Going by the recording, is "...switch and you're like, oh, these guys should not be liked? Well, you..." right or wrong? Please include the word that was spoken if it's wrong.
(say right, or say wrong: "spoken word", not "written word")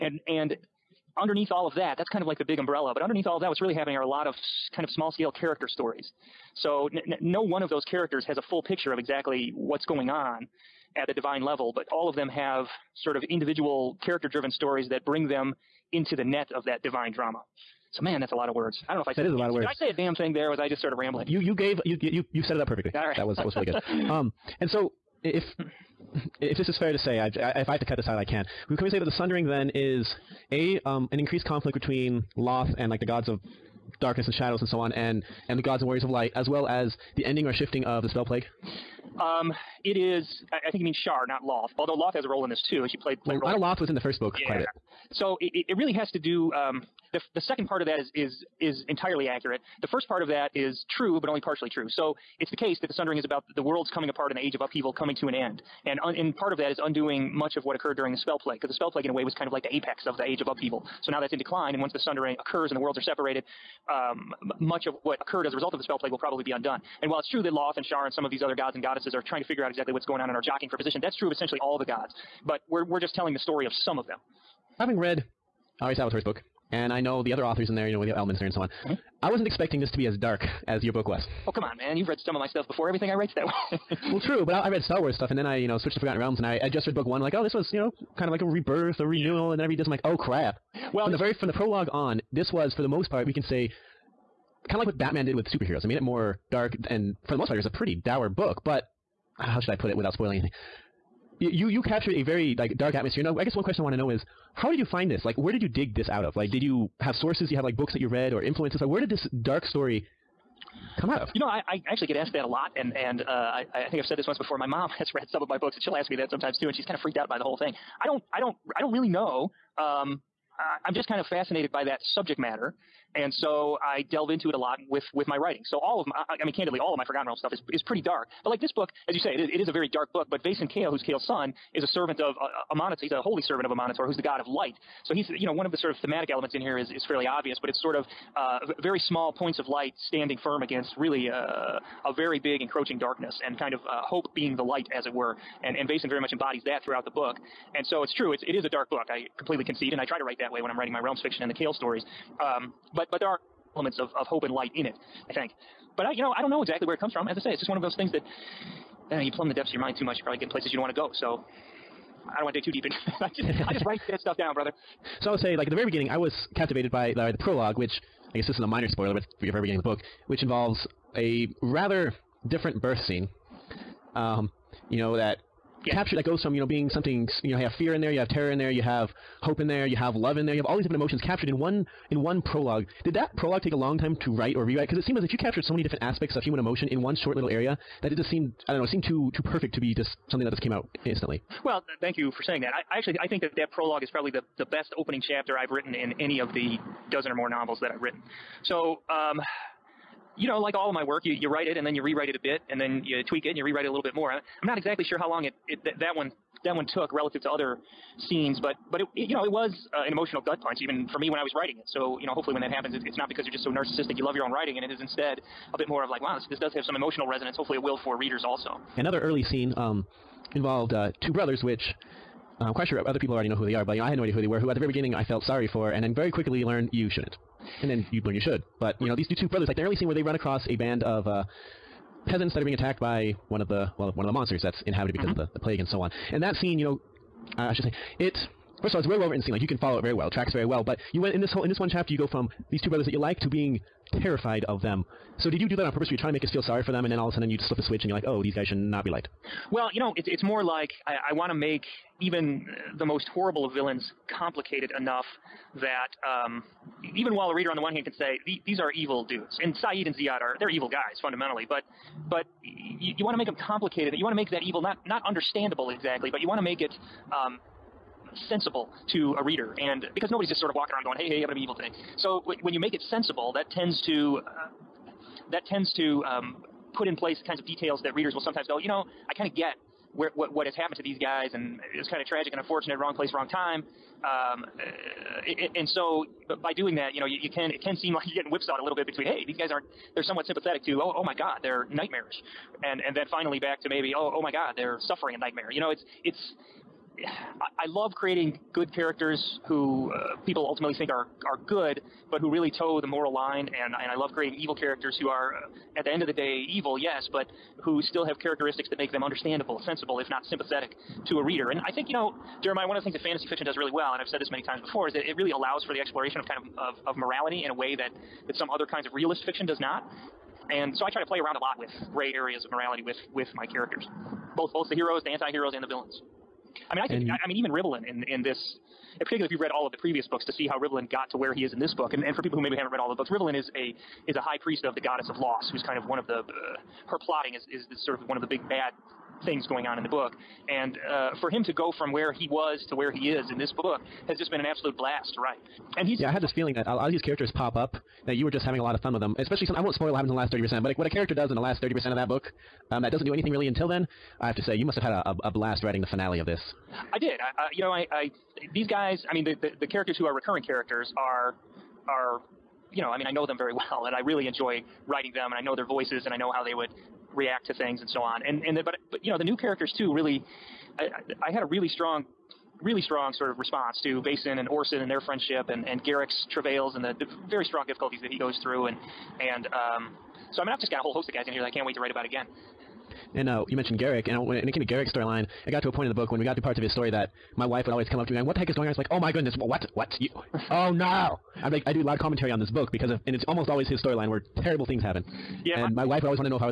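right.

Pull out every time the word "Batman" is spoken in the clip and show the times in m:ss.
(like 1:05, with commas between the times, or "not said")
1:34.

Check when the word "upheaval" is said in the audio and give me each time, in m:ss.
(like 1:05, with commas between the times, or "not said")
0:54, 1:00.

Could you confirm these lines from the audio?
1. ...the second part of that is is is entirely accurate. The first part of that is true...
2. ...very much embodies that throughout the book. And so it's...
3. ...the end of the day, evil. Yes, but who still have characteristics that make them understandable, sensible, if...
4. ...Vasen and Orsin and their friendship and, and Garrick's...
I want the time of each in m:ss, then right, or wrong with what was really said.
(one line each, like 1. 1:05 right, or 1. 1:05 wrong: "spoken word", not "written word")
1. 0:47 right
2. 2:26 right
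3. 5:06 right
4. 6:14 right.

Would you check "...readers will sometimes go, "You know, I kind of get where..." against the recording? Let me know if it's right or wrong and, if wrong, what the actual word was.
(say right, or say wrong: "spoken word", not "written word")
right.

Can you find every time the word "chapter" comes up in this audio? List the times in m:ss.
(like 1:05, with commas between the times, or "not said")
3:15, 4:01.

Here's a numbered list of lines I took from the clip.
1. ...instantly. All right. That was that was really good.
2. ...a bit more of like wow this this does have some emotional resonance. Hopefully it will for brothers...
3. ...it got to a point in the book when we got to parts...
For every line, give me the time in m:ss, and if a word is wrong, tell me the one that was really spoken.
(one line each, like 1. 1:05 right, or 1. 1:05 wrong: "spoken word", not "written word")
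1. 0:22 wrong: "perfectly", not "instantly"
2. 3:35 wrong: "readers", not "brothers"
3. 6:25 right.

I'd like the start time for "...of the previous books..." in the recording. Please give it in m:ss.
5:29.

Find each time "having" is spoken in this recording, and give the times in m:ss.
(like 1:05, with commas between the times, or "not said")
1:14, 5:48.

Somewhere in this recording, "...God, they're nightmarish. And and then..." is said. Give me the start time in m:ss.
4:51.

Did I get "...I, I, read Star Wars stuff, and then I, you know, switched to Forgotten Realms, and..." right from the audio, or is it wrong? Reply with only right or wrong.
right.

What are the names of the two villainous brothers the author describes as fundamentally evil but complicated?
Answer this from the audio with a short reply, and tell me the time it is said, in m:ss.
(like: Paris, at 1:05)
Saeed and Ziad, at 4:19.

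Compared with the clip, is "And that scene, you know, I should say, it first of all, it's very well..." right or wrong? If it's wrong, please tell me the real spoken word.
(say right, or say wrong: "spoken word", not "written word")
right.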